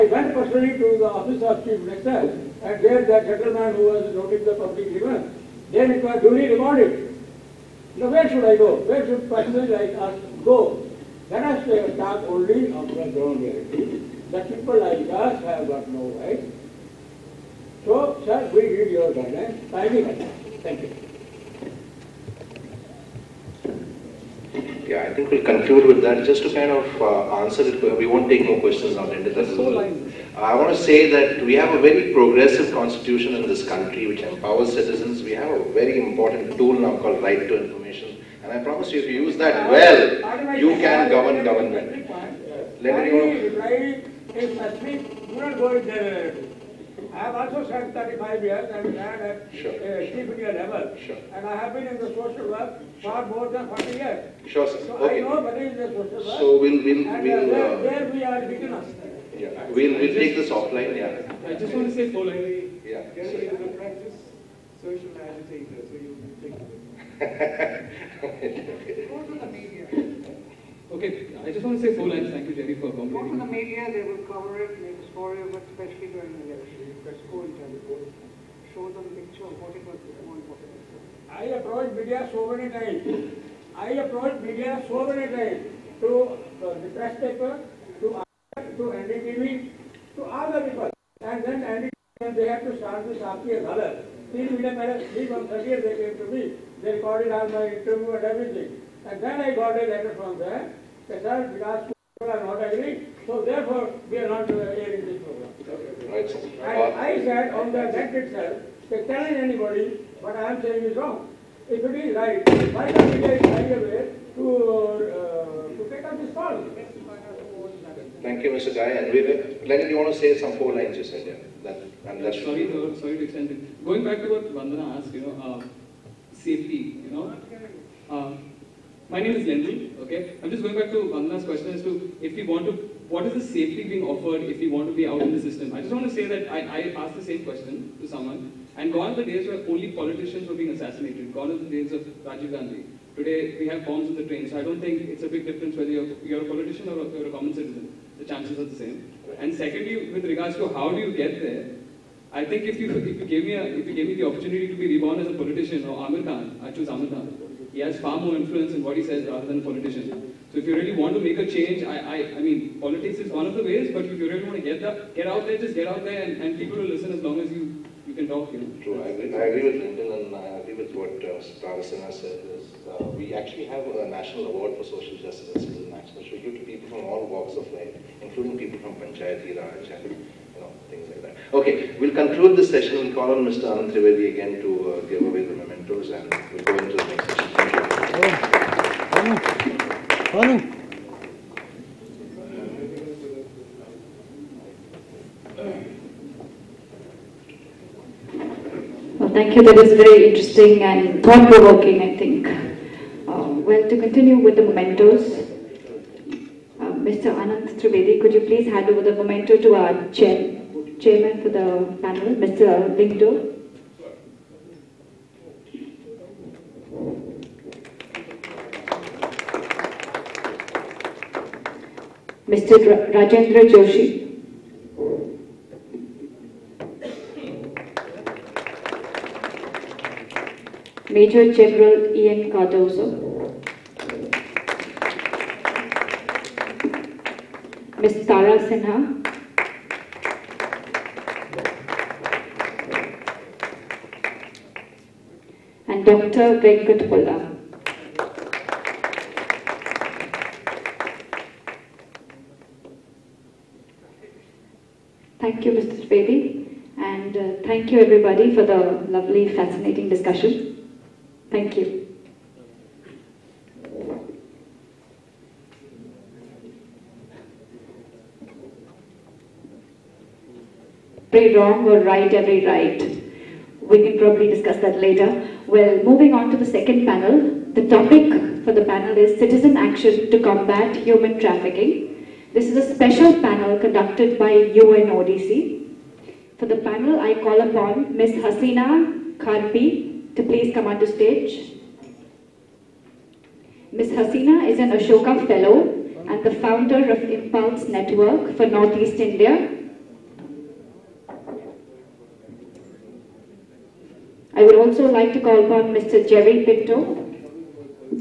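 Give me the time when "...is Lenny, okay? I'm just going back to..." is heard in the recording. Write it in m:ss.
2:09.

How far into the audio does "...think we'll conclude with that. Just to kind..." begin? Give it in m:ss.
0:25.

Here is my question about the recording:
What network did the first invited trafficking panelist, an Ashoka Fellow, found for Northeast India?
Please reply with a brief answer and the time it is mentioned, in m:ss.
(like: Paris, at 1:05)
Impulse Network, at 4:57.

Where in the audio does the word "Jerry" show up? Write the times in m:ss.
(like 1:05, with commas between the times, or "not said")
1:12, 5:06.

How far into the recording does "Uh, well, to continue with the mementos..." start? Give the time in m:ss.
3:23.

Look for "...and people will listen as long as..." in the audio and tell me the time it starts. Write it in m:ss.
2:46.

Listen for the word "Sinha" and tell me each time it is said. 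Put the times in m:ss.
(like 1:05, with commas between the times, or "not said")
2:51, 3:58.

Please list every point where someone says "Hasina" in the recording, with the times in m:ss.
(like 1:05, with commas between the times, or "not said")
4:48, 4:54.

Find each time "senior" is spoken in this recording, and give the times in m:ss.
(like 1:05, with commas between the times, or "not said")
0:50.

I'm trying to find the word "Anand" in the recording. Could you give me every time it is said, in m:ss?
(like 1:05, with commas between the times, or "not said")
3:03, 3:27.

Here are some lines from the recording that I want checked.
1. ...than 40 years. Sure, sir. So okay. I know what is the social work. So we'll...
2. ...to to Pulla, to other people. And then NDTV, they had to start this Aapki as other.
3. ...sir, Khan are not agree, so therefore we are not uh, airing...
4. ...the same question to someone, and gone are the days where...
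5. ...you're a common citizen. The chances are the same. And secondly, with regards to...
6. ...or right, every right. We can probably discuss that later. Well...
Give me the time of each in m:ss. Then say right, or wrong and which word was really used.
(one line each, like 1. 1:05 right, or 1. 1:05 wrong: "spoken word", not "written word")
1. 0:53 right
2. 1:28 wrong: "NDTV", not "Pulla"
3. 1:41 wrong: "Vikas", not "Khan"
4. 2:17 right
5. 2:27 right
6. 4:31 right.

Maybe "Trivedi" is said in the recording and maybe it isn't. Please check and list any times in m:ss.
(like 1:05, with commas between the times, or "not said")
3:03, 3:27.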